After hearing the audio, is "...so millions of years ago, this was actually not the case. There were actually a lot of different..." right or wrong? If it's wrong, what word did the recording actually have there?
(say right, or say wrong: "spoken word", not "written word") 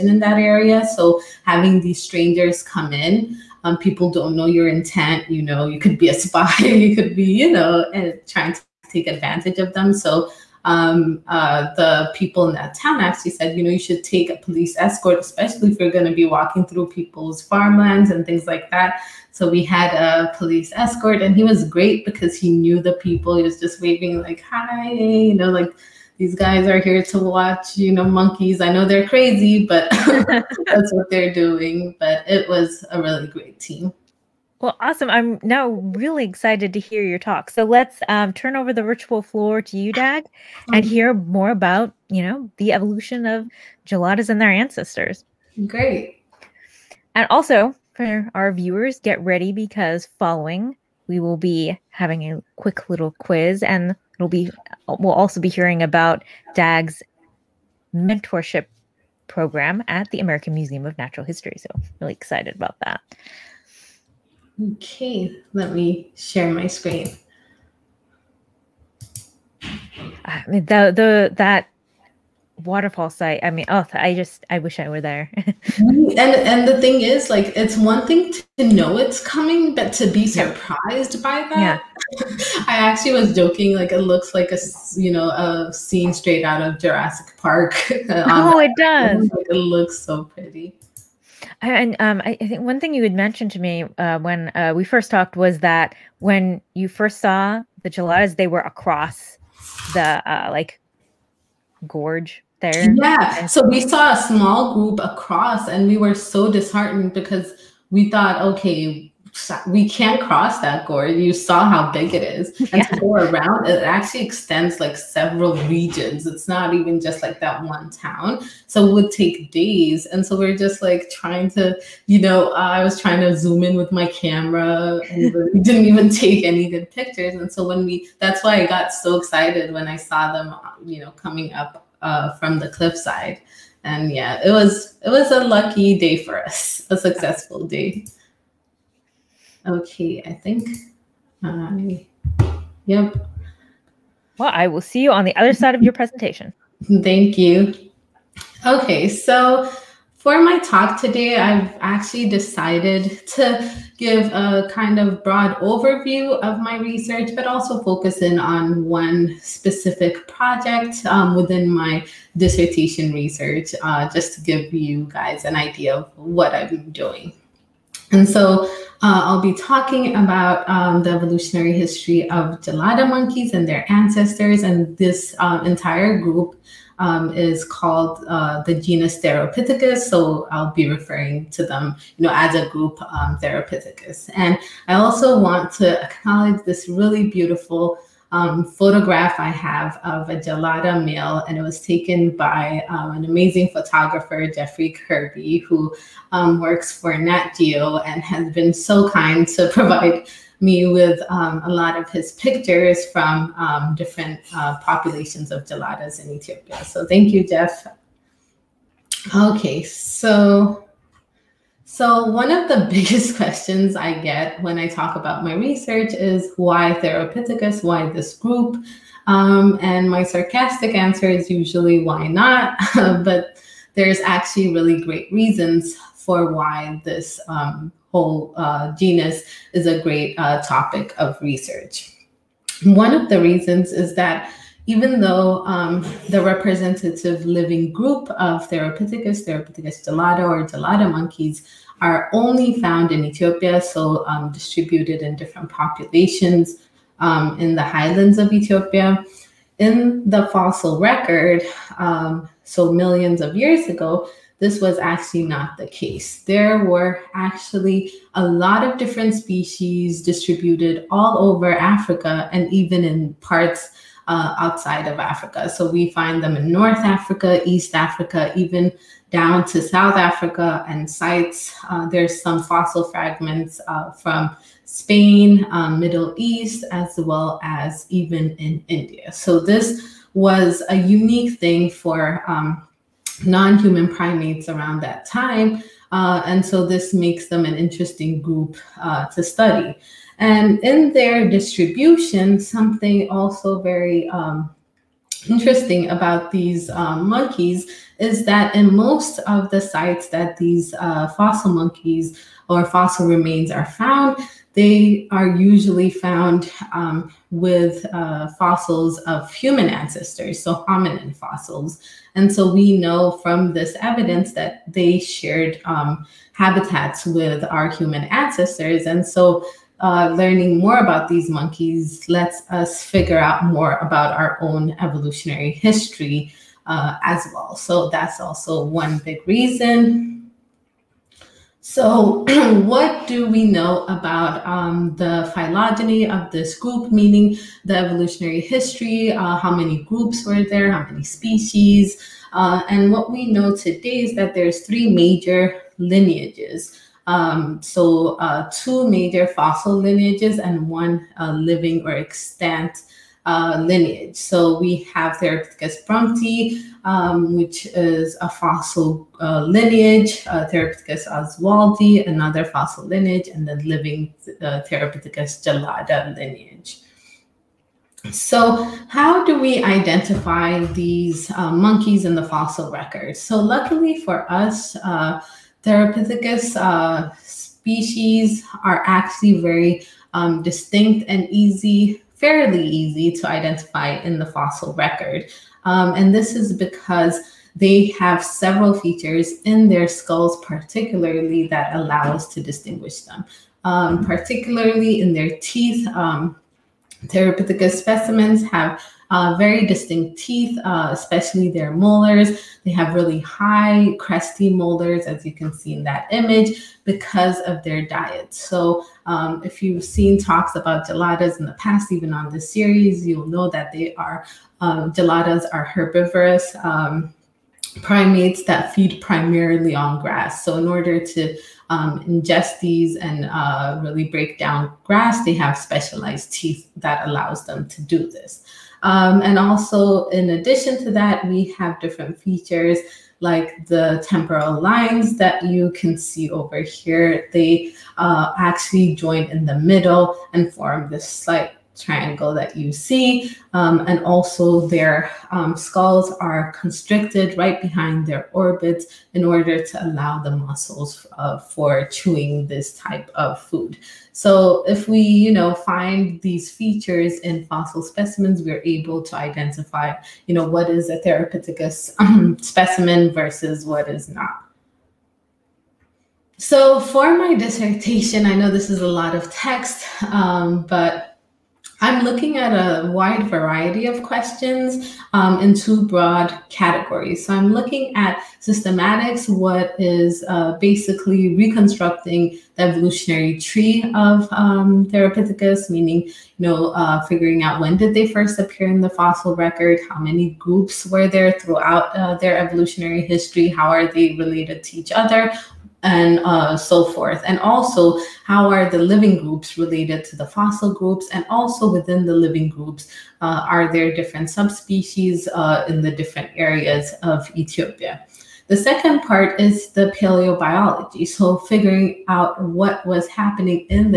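right.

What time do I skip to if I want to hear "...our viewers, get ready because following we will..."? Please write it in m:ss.
0:48.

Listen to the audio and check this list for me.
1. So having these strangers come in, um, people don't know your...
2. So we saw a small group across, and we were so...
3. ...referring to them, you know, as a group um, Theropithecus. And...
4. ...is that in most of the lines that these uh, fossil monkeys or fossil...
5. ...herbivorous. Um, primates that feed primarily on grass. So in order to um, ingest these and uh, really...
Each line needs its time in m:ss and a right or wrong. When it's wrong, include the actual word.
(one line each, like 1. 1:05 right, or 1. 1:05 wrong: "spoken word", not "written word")
1. 0:00 right
2. 1:43 right
3. 3:00 right
4. 4:58 wrong: "sites", not "lines"
5. 6:55 right.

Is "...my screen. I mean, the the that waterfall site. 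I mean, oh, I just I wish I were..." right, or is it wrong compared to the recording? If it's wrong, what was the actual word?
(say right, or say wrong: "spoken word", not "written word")
right.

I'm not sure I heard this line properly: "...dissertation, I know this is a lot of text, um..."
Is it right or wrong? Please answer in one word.
right.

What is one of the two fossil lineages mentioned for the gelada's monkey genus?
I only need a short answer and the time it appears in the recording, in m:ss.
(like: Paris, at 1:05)
Theropithecus brumpti, at 5:55.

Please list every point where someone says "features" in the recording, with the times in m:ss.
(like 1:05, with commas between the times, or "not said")
6:28, 7:12, 7:36.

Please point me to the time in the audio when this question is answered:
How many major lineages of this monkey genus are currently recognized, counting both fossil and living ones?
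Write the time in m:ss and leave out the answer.
5:44.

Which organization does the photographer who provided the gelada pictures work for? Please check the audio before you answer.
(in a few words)
Nat Geo.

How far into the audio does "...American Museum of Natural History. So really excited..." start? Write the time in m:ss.
1:00.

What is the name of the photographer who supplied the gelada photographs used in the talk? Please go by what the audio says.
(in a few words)
Jeffrey Kerby.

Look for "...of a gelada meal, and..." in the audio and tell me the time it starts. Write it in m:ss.
3:10.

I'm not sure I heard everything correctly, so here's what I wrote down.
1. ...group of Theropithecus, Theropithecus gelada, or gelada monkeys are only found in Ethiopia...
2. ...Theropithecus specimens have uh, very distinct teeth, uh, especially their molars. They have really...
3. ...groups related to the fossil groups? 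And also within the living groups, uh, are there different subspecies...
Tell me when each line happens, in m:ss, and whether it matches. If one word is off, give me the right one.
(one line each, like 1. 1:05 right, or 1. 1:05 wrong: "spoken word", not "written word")
1. 3:57 right
2. 6:37 right
3. 8:19 right.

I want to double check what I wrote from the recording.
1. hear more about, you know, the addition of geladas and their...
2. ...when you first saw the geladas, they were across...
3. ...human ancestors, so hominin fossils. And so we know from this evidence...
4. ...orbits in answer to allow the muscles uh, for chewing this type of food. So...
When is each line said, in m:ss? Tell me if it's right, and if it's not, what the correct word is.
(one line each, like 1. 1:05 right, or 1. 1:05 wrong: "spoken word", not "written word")
1. 0:40 wrong: "evolution", not "addition"
2. 1:36 right
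3. 5:09 right
4. 7:28 wrong: "order", not "answer".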